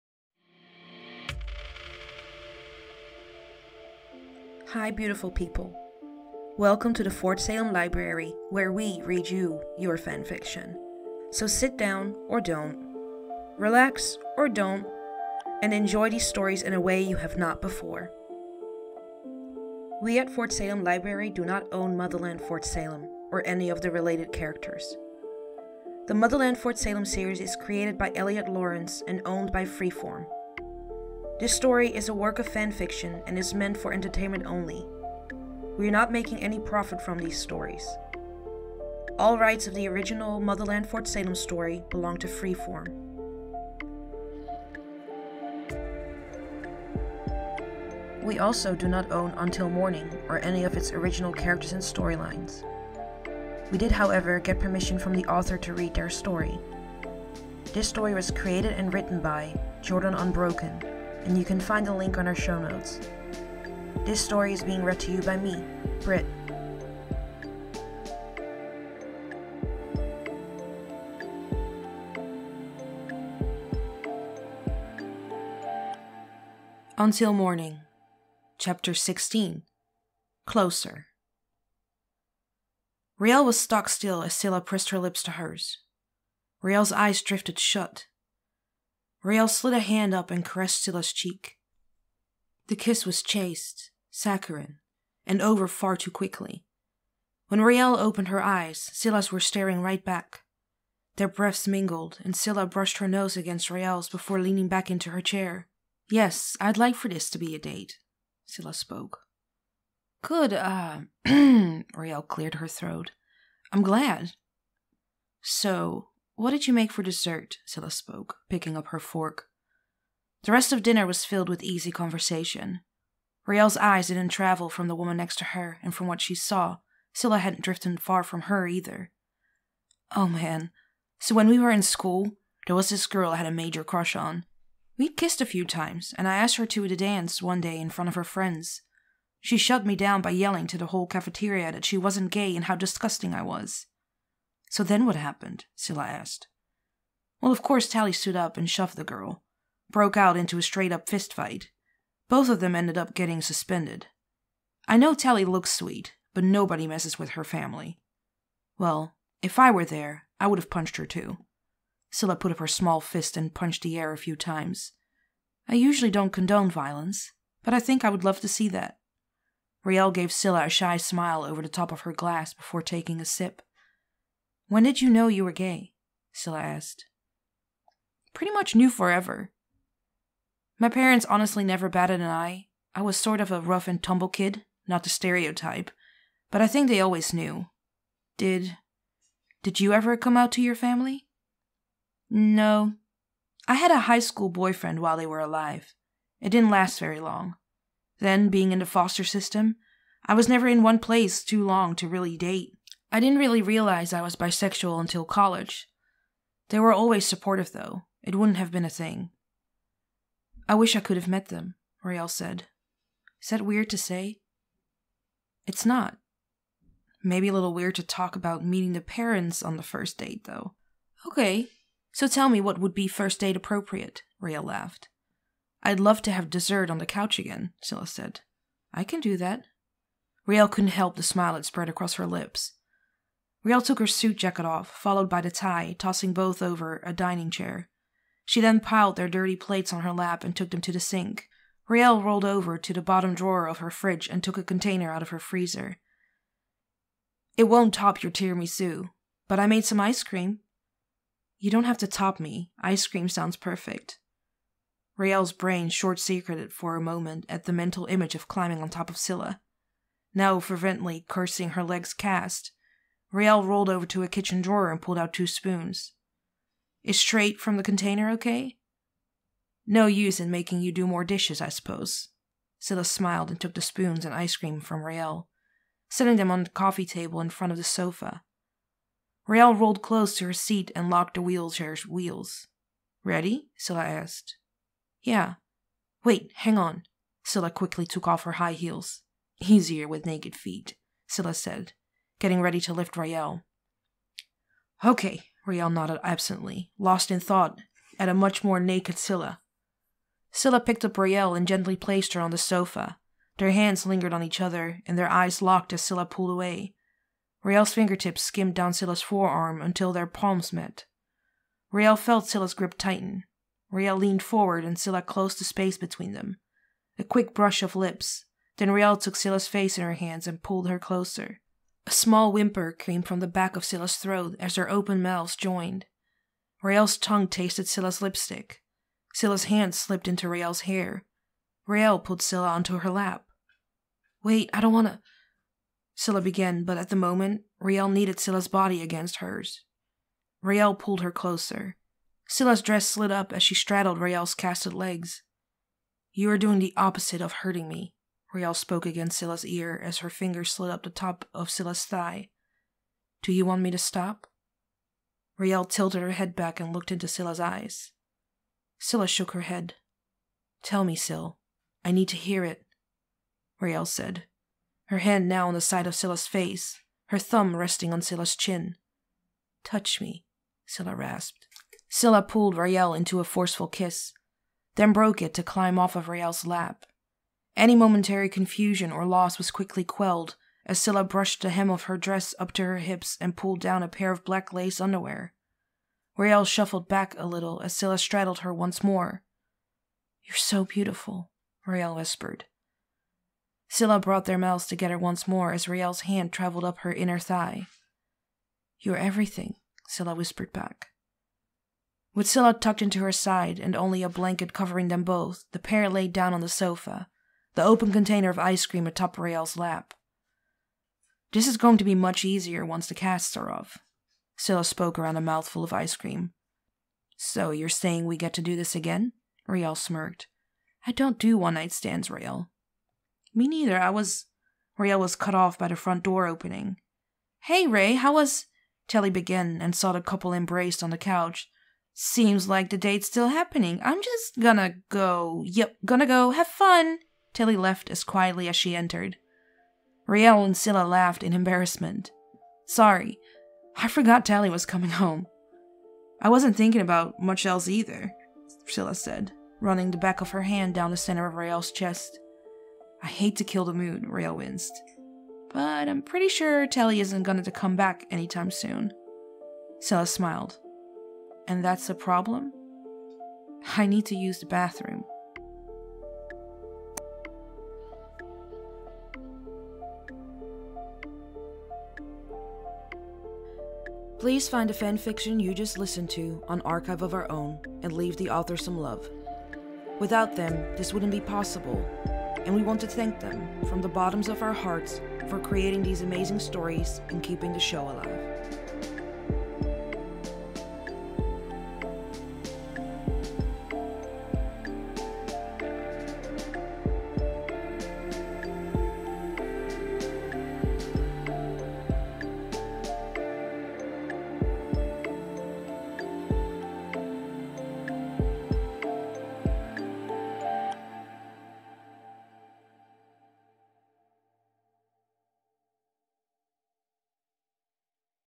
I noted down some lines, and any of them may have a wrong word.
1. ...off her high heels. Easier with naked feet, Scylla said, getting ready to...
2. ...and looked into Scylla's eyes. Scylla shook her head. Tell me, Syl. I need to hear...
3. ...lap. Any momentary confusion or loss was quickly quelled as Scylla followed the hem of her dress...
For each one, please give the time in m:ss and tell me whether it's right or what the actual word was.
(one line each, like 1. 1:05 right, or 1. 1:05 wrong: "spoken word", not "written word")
1. 4:48 right
2. 5:56 right
3. 6:16 wrong: "brushed", not "followed".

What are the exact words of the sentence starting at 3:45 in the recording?
I'd love to have dessert on the couch again, Scylla said.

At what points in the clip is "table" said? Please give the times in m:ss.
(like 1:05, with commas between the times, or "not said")
4:37.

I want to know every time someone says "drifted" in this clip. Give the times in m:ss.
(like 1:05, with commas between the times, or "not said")
1:27, 2:07.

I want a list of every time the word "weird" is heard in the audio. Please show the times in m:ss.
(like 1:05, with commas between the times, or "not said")
3:33, 3:37.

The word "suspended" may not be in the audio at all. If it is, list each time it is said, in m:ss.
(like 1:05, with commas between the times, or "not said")
2:33.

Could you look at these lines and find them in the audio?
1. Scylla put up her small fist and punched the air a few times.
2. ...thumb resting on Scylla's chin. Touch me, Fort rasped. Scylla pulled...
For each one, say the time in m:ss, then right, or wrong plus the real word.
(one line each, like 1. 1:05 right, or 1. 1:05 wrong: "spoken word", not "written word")
1. 2:42 right
2. 6:07 wrong: "Scylla", not "Fort".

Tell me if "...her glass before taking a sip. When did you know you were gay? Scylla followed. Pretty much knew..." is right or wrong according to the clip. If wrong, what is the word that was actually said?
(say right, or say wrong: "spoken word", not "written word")
wrong: "asked", not "followed".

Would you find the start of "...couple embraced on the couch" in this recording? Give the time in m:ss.
7:10.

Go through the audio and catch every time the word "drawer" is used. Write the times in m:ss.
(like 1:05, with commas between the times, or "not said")
4:03, 4:24.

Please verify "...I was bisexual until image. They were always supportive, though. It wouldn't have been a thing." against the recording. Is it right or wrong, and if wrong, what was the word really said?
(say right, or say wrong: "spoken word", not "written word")
wrong: "college", not "image".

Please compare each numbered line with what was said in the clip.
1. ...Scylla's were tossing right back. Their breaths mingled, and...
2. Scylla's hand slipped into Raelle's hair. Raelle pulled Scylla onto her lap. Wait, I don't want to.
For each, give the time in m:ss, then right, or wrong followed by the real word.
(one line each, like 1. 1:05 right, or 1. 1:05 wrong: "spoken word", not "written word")
1. 1:38 wrong: "staring", not "tossing"
2. 5:29 right.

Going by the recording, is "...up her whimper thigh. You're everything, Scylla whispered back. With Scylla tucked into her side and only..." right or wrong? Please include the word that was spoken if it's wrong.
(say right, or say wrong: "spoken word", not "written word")
wrong: "inner", not "whimper".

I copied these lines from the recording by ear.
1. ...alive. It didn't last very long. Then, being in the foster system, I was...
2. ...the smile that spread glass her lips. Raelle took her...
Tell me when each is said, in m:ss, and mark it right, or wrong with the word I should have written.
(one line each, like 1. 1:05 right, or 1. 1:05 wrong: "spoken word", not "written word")
1. 3:15 right
2. 3:51 wrong: "across", not "glass".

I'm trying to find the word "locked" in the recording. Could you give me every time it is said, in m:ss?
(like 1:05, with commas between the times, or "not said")
4:41, 5:05.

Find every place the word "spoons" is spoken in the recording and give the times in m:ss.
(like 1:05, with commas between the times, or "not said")
4:25, 4:33.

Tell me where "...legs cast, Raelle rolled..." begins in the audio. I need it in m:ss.
4:21.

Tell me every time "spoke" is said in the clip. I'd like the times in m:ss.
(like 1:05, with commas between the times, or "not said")
1:48, 1:57, 5:48, 6:54.